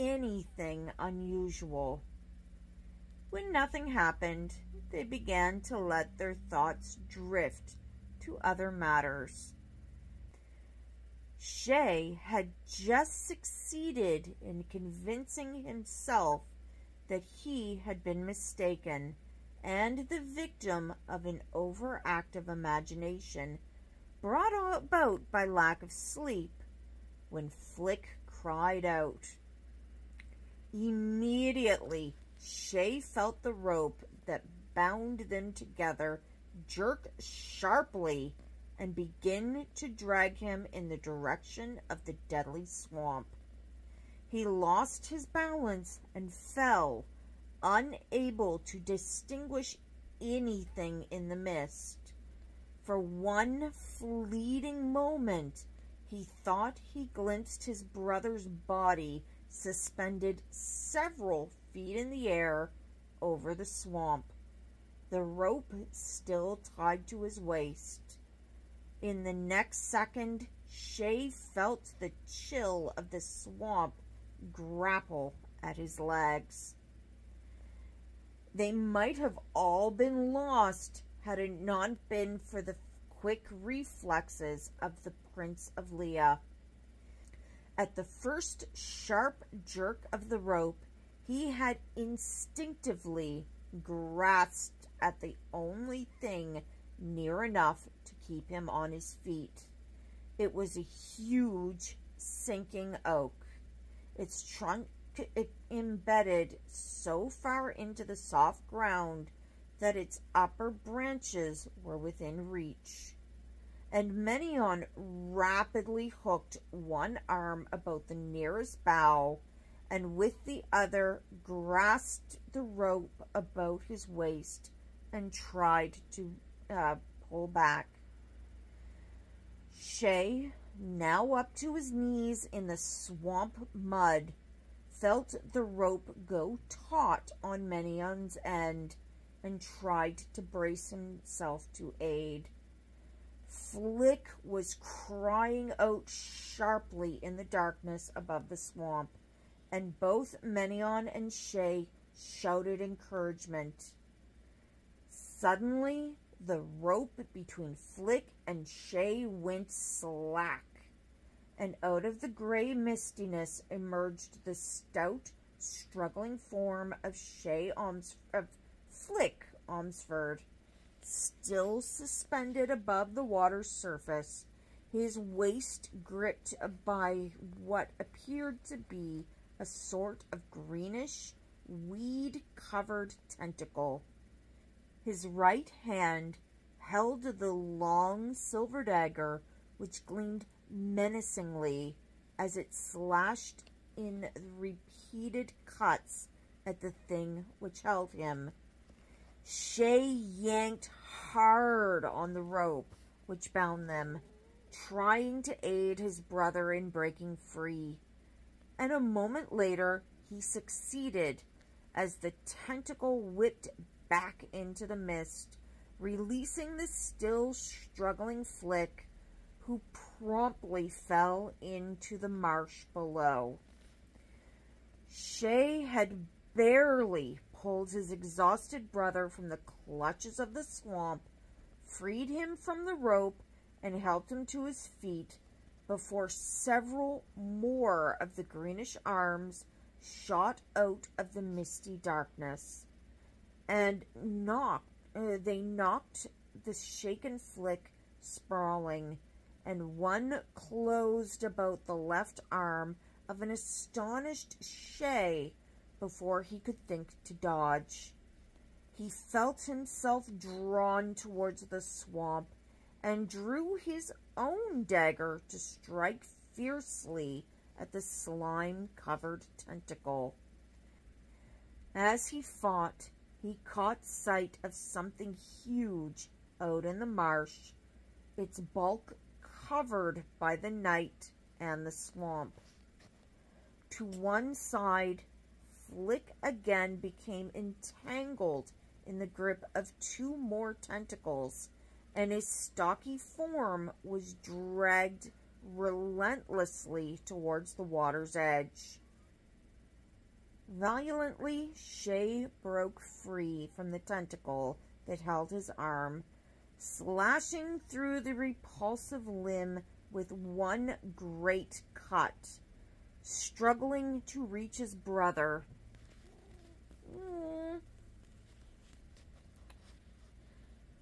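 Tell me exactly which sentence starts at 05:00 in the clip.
Violently, Shea broke free from the tentacle that held his arm, slashing through the repulsive limb with one great cut.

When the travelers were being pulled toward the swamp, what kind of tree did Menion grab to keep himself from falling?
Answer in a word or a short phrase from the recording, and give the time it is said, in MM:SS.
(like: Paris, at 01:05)
sinking oak, at 01:42.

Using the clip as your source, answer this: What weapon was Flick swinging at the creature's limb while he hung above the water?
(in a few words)
silver dagger.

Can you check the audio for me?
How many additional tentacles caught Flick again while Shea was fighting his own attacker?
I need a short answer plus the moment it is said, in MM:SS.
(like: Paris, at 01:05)
2, at 04:49.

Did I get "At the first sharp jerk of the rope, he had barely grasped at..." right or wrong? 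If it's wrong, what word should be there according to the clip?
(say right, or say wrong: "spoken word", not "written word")
wrong: "instinctively", not "barely".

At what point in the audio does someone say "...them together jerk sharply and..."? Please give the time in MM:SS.
00:35.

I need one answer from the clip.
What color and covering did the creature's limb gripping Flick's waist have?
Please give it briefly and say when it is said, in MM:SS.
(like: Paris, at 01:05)
greenish, weed-covered, at 03:00.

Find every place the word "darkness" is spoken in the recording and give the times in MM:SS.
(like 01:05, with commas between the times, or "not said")
02:27, 04:02.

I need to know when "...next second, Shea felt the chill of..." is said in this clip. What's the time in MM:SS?
01:09.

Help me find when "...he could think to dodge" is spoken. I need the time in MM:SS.
04:16.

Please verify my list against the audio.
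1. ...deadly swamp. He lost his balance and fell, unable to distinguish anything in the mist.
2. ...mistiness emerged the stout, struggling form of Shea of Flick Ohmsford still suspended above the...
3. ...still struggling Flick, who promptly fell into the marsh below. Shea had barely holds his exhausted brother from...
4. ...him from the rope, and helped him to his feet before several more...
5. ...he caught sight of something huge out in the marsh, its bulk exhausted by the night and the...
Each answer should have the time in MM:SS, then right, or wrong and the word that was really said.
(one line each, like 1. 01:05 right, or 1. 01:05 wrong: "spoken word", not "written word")
1. 00:42 right
2. 02:42 right
3. 03:36 right
4. 03:52 right
5. 04:33 wrong: "covered", not "exhausted".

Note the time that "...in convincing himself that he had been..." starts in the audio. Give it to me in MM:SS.
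00:14.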